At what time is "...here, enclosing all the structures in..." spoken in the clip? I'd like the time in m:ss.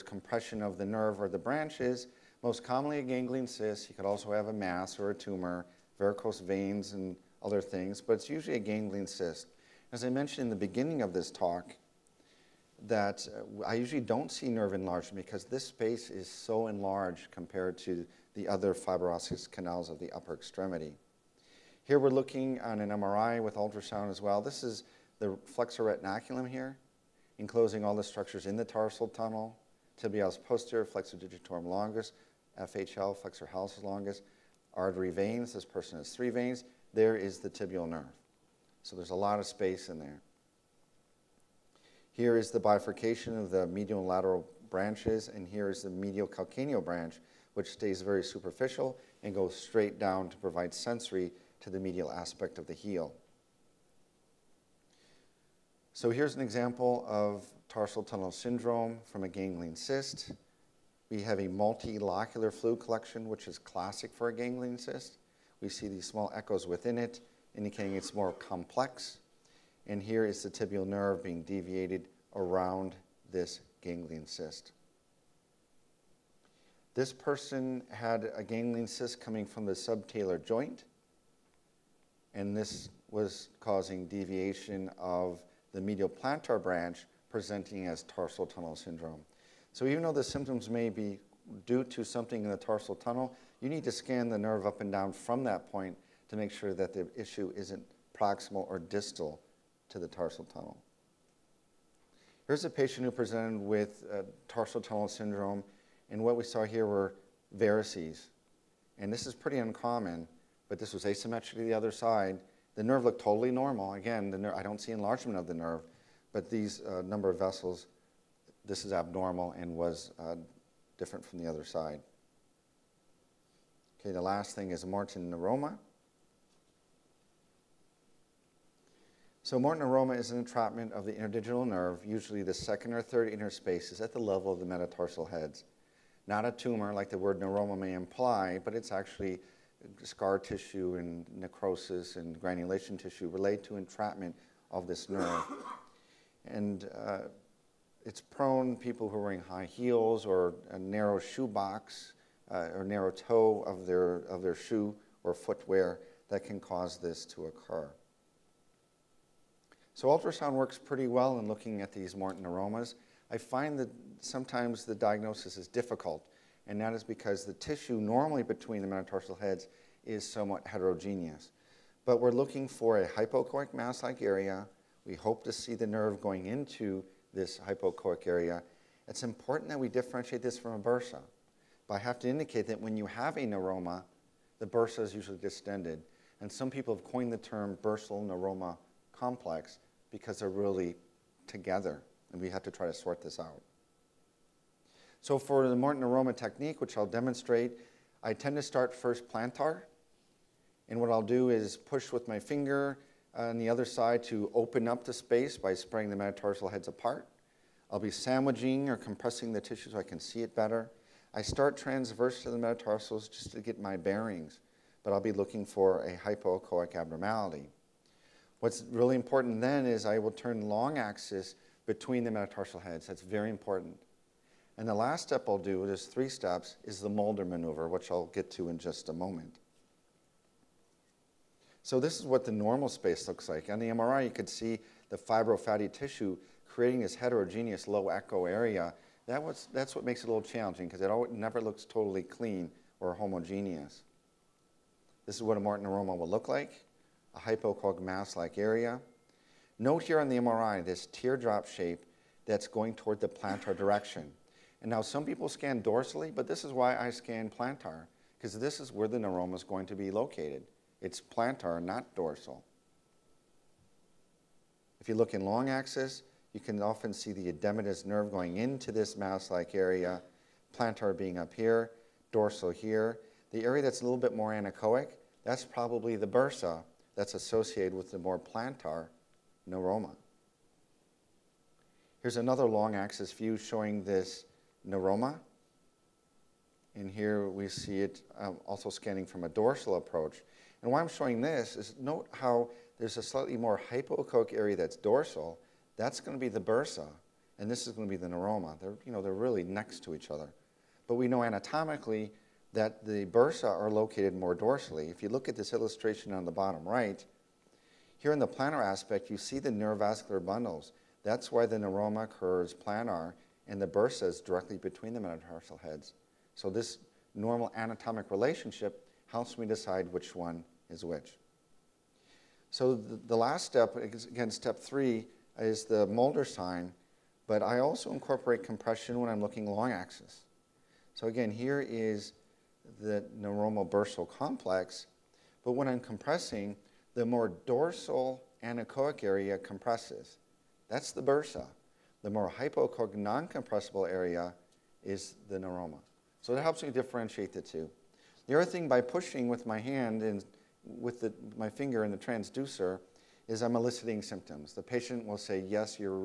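0:26.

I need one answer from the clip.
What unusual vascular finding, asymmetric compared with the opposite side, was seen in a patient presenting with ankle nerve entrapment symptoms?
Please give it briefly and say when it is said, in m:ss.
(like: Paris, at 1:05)
Varices, at 1:47.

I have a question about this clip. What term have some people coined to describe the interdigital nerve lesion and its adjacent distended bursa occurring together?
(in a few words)
Bursal neuroma complex.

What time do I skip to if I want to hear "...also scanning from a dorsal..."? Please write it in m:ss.
4:48.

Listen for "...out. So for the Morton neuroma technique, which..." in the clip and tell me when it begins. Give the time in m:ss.
3:13.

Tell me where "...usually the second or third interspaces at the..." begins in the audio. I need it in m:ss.
2:12.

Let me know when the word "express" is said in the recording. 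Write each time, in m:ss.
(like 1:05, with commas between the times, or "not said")
not said.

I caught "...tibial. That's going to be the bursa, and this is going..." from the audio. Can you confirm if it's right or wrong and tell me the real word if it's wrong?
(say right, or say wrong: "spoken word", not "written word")
wrong: "dorsal", not "tibial".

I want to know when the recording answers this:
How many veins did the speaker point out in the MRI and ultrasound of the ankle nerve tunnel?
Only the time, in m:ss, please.
0:36.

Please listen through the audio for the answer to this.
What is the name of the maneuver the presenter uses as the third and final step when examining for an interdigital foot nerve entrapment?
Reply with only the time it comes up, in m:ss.
3:47.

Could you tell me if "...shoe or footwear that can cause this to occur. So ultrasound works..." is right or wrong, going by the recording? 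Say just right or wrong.
right.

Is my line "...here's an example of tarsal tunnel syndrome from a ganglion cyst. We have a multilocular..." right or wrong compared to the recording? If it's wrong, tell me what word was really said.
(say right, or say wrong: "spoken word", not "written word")
right.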